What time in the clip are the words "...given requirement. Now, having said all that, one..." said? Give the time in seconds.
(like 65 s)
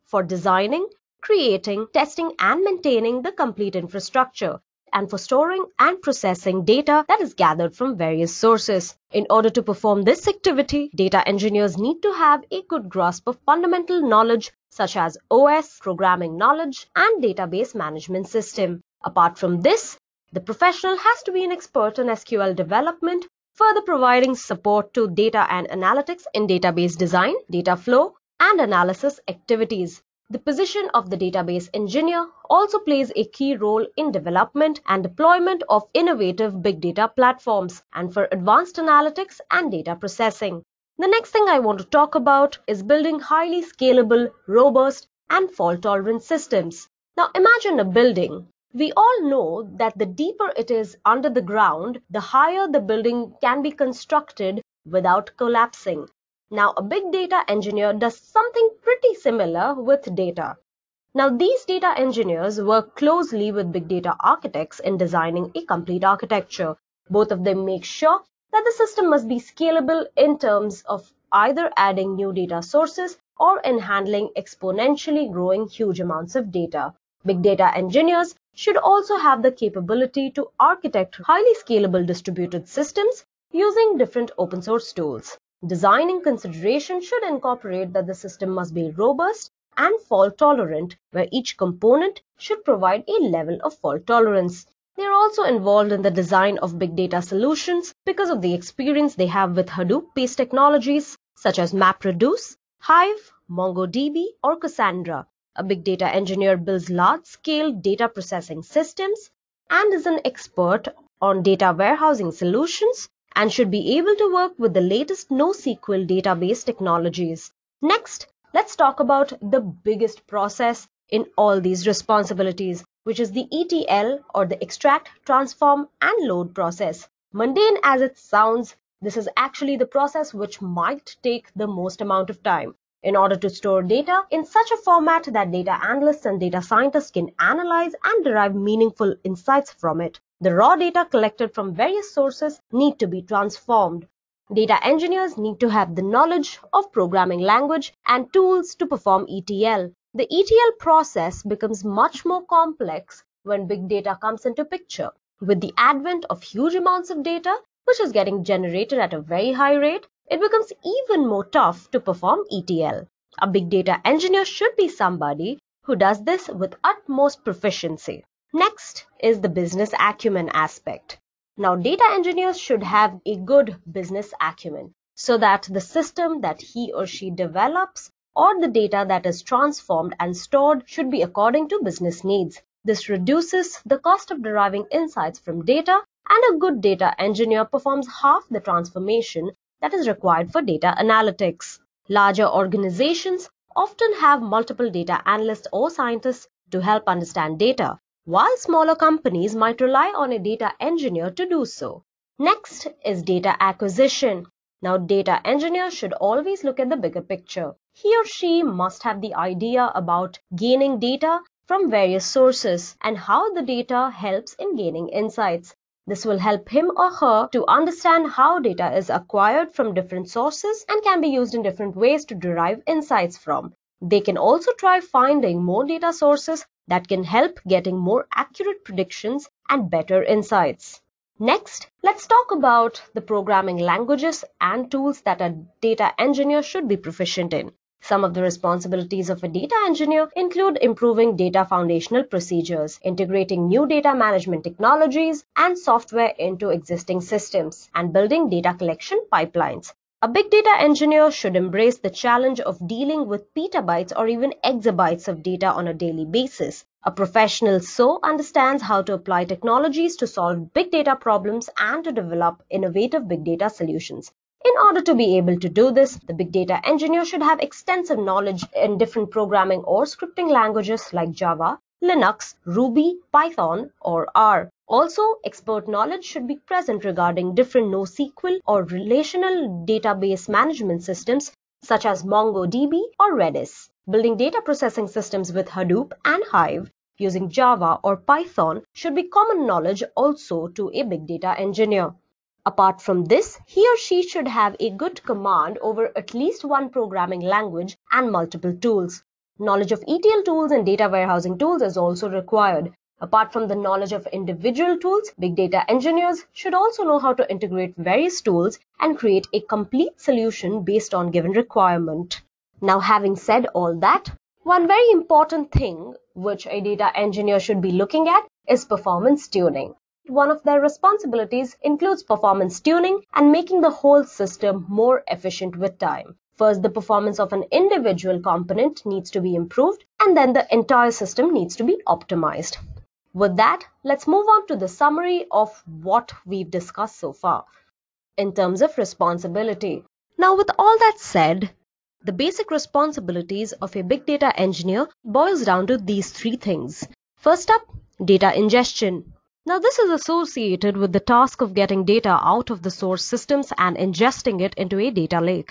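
311 s.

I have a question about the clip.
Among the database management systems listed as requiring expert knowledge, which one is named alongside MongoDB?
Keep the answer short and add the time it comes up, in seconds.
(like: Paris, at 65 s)
Redis, at 283 s.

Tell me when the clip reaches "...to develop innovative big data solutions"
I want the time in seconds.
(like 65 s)
262 s.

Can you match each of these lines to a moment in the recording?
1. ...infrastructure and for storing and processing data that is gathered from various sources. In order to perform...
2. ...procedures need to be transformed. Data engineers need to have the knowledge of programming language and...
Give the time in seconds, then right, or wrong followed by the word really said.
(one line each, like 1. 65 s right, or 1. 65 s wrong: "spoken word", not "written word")
1. 3 s right
2. 142 s wrong: "sources", not "procedures".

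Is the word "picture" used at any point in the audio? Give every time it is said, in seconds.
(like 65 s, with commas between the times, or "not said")
154 s, 207 s.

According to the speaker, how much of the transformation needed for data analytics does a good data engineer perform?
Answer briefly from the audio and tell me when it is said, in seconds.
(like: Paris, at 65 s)
Half, at 188 s.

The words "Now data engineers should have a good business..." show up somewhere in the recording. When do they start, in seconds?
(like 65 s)
171 s.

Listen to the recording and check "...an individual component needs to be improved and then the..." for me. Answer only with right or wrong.
right.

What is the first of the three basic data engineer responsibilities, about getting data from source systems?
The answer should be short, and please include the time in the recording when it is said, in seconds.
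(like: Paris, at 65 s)
Data ingestion, at 348 s.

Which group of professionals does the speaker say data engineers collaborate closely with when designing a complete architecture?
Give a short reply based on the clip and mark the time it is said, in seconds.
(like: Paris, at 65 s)
Big data architects, at 63 s.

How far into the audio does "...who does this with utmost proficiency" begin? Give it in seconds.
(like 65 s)
165 s.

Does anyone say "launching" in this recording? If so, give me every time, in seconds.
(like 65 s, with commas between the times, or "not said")
not said.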